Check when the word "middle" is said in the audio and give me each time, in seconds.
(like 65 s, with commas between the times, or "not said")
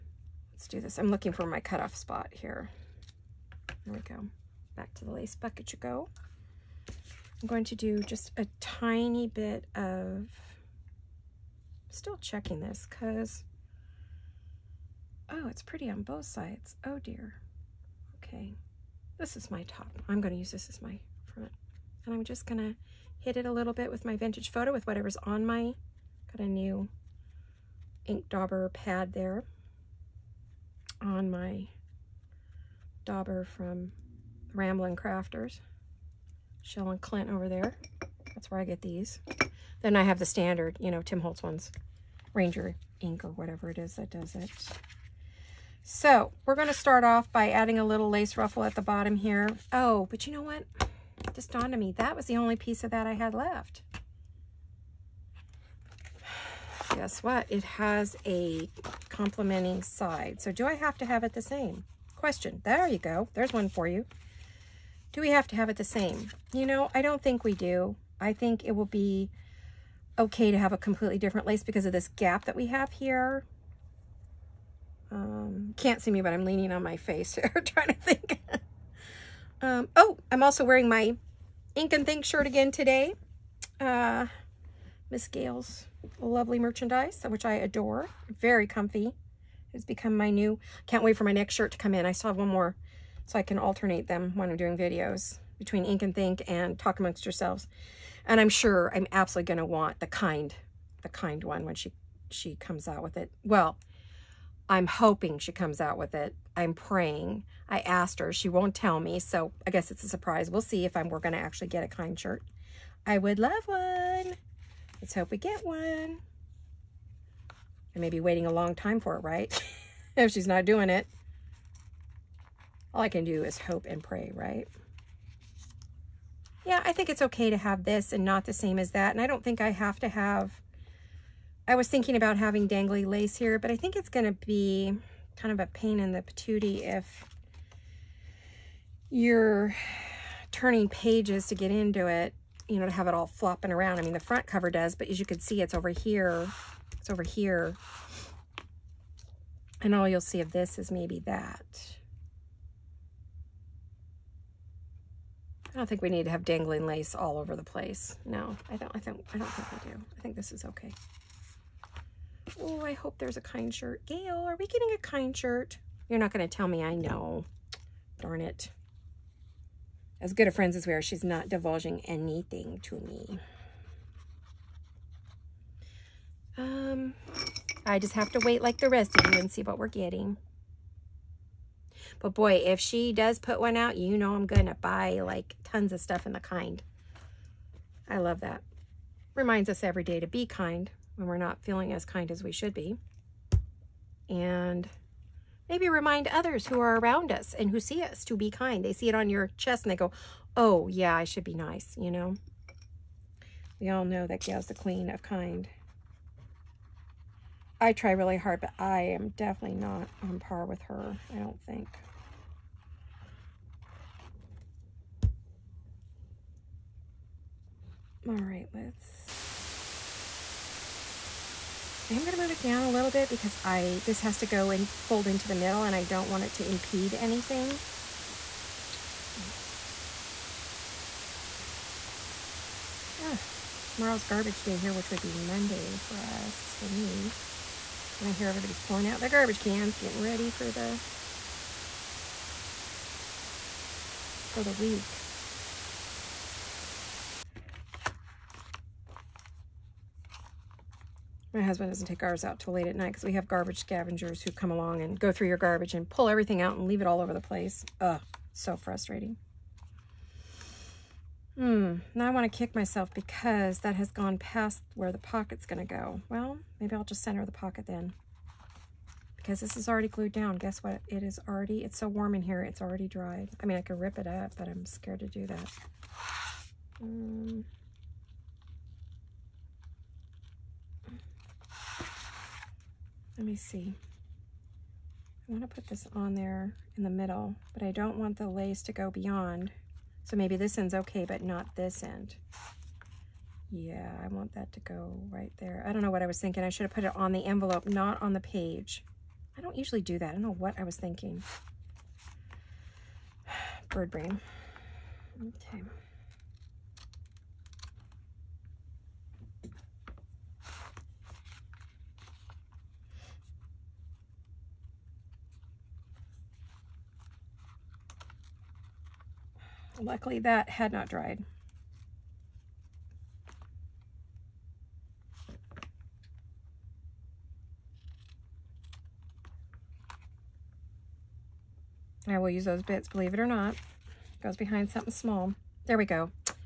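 225 s, 287 s.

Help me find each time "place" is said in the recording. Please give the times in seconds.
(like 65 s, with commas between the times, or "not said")
157 s, 257 s.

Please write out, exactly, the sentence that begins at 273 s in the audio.
I mean, I could rip it up, but I'm scared to do that.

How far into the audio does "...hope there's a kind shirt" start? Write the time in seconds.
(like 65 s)
162 s.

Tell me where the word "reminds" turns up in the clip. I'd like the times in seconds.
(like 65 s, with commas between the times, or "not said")
189 s, 195 s.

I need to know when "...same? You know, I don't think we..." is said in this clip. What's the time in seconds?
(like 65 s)
65 s.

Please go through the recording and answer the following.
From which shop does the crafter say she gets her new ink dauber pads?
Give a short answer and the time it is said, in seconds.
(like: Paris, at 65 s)
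Ramblin' Crafters, at 34 s.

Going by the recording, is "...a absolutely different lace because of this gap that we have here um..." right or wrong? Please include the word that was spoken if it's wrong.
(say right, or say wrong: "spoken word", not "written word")
wrong: "completely", not "absolutely".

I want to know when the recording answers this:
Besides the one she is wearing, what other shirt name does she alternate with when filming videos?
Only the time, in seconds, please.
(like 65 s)
96 s.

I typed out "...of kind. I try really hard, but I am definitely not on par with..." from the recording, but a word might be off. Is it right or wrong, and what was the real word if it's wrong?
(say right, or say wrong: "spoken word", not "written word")
right.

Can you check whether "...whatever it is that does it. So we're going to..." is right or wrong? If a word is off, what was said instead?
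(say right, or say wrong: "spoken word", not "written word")
right.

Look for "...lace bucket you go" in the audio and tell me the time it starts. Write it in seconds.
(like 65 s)
5 s.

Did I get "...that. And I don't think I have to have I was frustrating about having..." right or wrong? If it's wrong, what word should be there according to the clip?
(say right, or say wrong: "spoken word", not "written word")
wrong: "thinking", not "frustrating".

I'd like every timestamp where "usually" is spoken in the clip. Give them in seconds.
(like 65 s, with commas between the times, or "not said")
299 s.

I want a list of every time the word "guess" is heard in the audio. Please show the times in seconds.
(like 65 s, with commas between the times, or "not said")
56 s, 109 s, 270 s.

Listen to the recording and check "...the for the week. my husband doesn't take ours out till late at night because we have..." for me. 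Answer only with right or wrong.
right.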